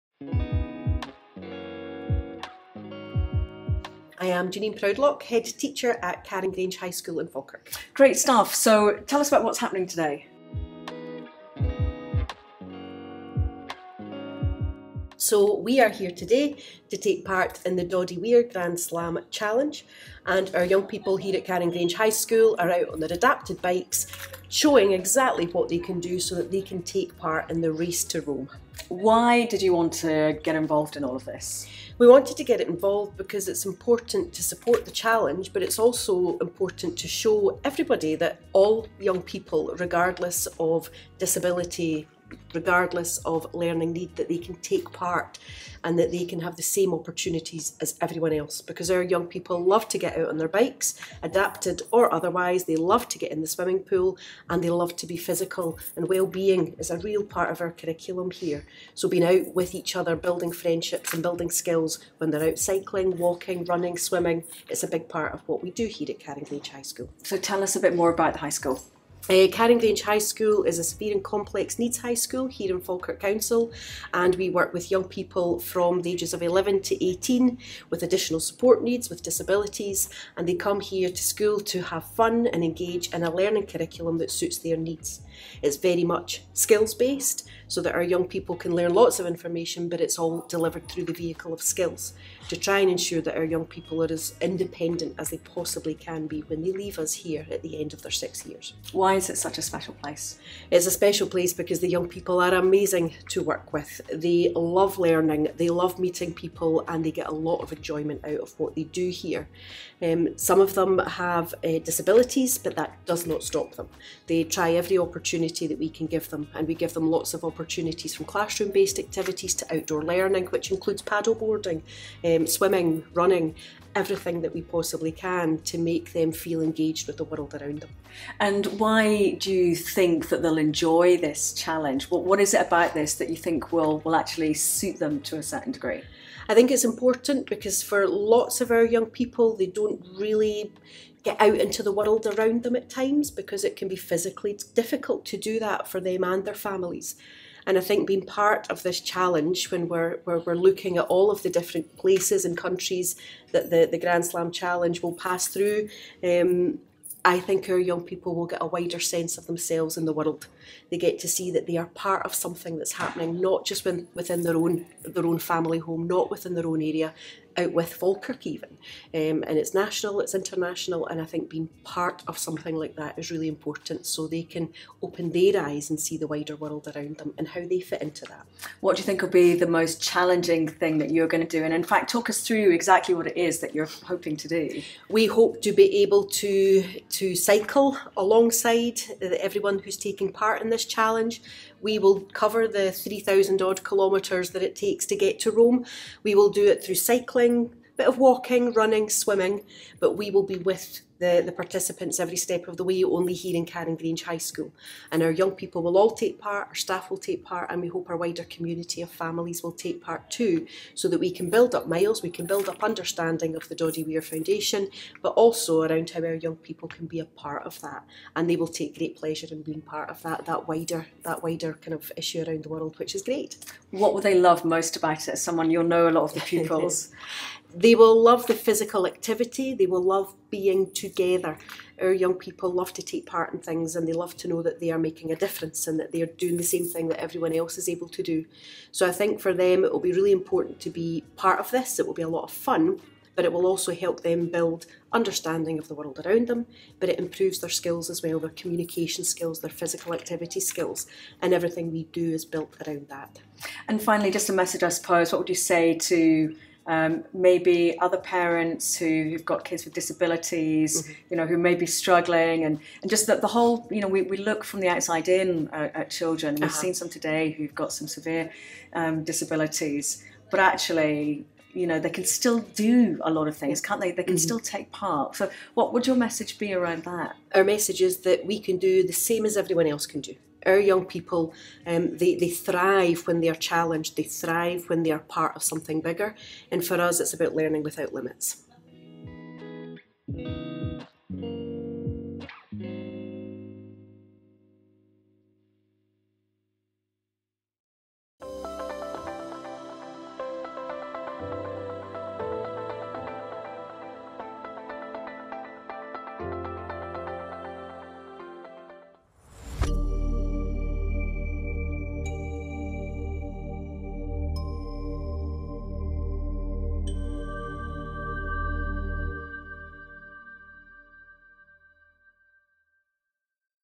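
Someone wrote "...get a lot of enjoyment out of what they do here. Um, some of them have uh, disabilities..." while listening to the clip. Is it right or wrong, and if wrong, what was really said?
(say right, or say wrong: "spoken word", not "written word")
right.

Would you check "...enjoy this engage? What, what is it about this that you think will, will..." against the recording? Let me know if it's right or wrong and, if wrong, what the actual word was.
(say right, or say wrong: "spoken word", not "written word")
wrong: "challenge", not "engage".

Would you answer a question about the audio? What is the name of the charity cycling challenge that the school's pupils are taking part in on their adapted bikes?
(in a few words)
Doddie Weir Grand Slam Challenge.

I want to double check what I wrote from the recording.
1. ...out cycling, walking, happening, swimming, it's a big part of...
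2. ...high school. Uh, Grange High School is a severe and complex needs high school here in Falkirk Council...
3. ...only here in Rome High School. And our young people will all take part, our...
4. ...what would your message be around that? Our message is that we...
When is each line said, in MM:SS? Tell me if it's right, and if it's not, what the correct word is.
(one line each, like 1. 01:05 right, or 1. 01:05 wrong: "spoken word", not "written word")
1. 01:02 wrong: "running", not "happening"
2. 01:08 right
3. 03:23 wrong: "Carrongrange", not "Rome"
4. 04:35 right.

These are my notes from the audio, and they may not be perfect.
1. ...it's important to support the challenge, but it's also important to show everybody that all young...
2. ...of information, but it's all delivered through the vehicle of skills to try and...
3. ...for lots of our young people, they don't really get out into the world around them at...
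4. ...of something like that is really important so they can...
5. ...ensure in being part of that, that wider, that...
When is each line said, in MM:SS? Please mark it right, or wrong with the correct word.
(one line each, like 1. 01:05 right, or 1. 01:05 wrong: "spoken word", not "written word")
1. 00:33 right
2. 01:29 right
3. 02:17 right
4. 02:52 right
5. 03:39 wrong: "pleasure", not "ensure".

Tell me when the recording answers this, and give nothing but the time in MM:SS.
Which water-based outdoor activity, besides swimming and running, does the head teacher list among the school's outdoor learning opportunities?
02:01.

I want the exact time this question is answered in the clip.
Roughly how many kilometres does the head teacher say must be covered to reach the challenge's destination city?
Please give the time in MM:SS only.
03:12.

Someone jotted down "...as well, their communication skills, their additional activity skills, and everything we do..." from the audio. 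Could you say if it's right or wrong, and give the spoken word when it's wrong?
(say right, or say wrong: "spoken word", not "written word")
wrong: "physical", not "additional".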